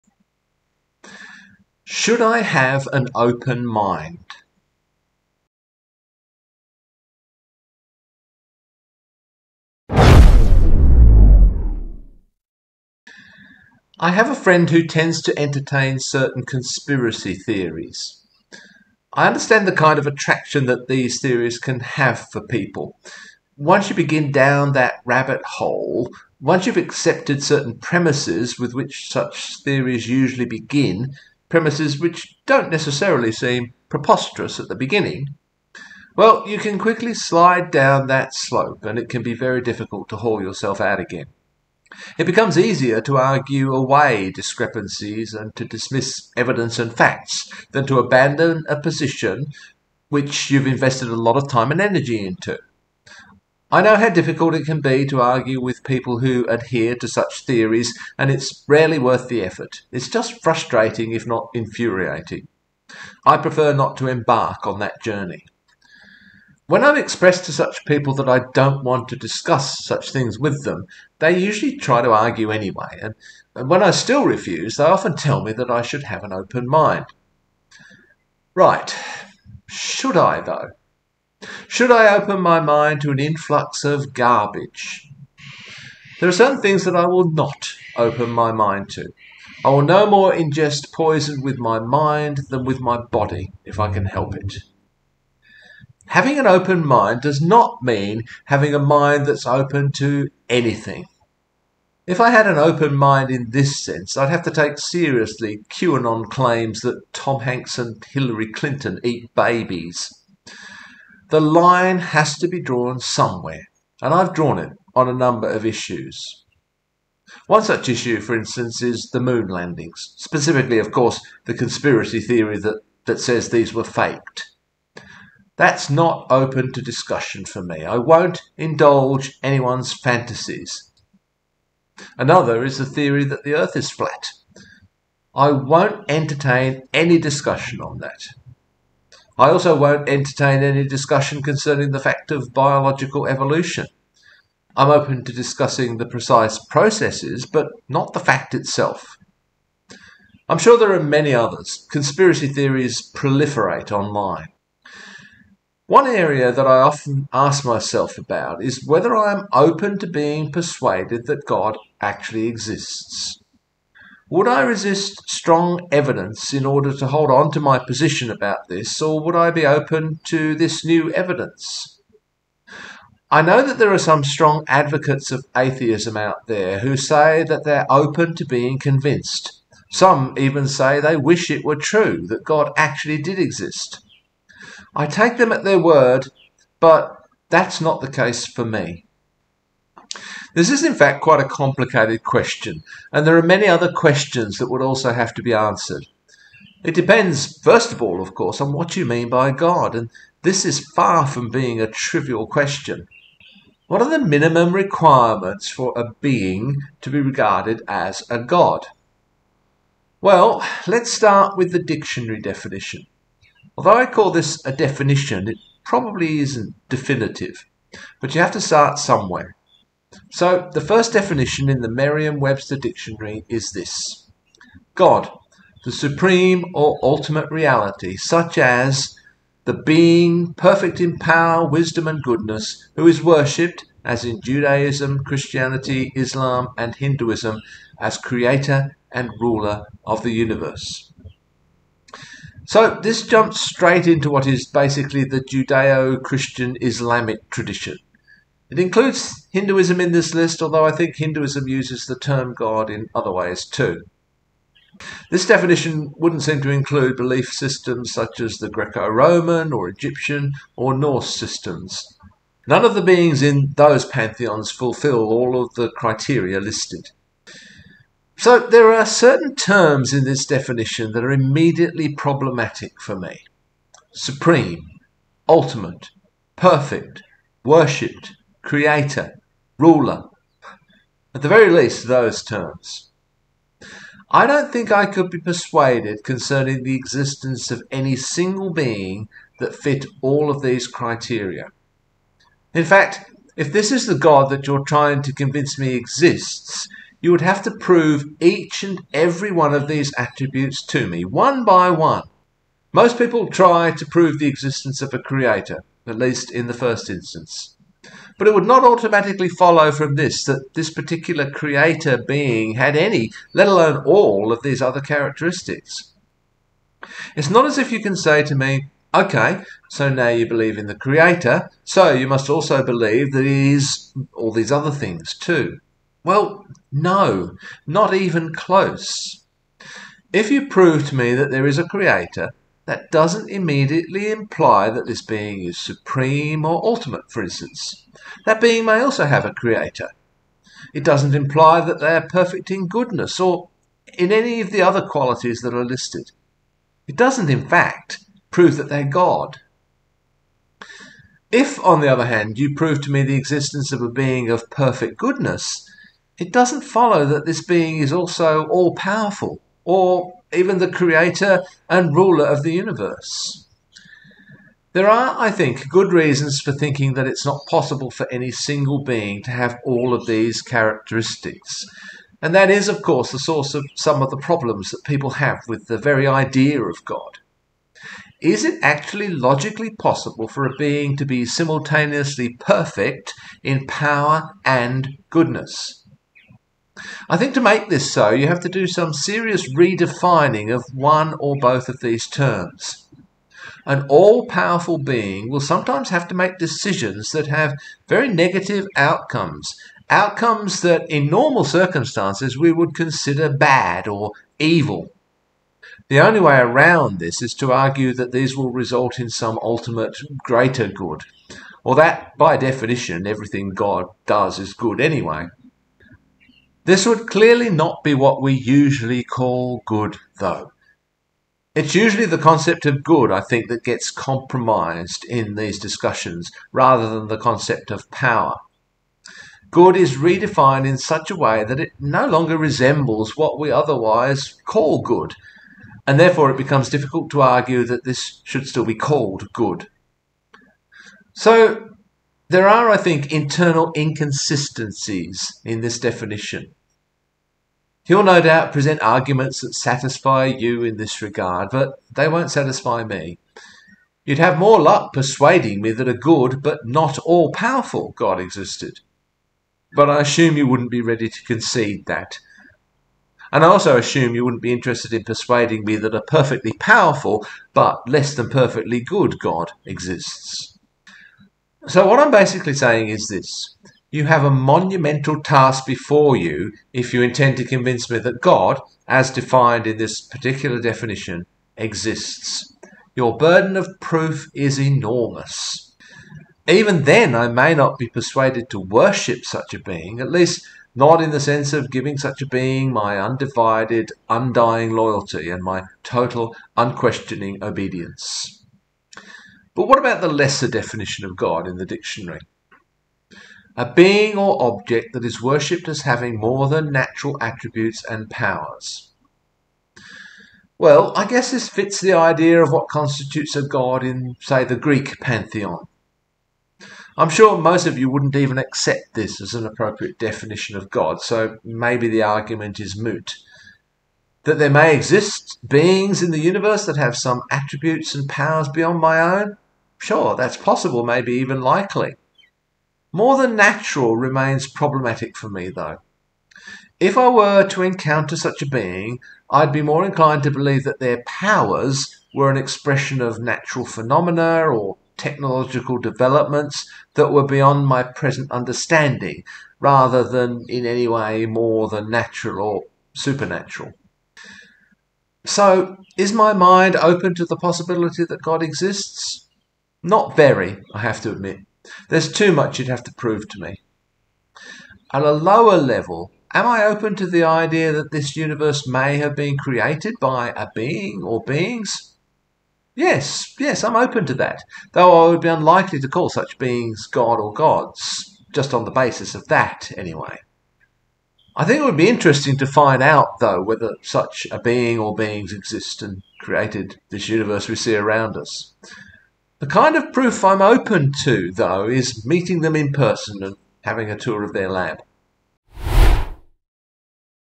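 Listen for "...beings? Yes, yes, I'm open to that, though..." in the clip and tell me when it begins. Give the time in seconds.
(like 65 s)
571 s.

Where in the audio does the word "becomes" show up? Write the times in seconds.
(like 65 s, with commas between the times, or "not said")
42 s, 436 s.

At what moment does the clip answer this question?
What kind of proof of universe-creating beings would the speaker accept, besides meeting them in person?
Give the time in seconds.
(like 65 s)
594 s.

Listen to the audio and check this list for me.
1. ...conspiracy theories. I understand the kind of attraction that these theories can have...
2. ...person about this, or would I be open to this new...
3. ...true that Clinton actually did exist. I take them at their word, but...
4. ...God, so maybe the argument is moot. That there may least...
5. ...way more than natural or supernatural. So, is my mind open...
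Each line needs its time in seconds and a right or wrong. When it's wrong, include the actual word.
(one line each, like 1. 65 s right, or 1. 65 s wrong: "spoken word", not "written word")
1. 16 s right
2. 167 s wrong: "position", not "person"
3. 181 s wrong: "God", not "Clinton"
4. 520 s wrong: "exist", not "least"
5. 551 s right.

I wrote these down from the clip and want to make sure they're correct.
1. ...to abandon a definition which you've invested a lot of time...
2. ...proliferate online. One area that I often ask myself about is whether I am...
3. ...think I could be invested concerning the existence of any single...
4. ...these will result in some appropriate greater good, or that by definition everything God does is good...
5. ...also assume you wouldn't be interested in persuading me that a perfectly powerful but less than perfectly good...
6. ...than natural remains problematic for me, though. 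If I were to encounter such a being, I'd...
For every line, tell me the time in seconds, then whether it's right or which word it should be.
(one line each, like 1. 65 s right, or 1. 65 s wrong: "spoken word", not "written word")
1. 47 s wrong: "position", not "definition"
2. 153 s right
3. 284 s wrong: "persuaded", not "invested"
4. 408 s wrong: "ultimate", not "appropriate"
5. 463 s right
6. 533 s right.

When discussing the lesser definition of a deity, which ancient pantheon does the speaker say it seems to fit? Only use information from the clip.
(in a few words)
the Greek pantheon.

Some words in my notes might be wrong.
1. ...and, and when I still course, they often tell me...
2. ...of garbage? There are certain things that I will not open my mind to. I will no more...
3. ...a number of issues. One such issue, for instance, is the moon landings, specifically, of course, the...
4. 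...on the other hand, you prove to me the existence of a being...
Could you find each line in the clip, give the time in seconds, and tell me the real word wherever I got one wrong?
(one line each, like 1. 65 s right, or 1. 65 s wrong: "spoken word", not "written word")
1. 73 s wrong: "refuse", not "course"
2. 83 s right
3. 115 s right
4. 351 s right.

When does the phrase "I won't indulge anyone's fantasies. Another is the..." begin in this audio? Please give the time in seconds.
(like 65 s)
127 s.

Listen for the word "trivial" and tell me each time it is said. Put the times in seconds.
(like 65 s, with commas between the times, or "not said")
201 s.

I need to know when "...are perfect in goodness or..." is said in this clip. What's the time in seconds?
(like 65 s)
342 s.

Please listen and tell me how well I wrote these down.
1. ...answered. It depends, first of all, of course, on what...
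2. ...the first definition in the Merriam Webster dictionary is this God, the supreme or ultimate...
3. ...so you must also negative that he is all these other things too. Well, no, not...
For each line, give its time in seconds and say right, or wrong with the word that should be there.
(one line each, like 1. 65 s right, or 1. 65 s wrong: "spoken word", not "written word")
1. 195 s right
2. 220 s right
3. 321 s wrong: "believe", not "negative".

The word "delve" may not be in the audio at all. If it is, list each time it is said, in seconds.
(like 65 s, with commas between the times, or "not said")
not said.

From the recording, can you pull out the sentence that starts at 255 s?
This definition wouldn't seem to include belief systems such as the Greco Roman or Egyptian or Norse systems.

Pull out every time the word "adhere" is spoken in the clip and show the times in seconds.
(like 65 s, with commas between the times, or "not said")
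56 s.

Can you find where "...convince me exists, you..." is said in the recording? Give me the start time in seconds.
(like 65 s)
295 s.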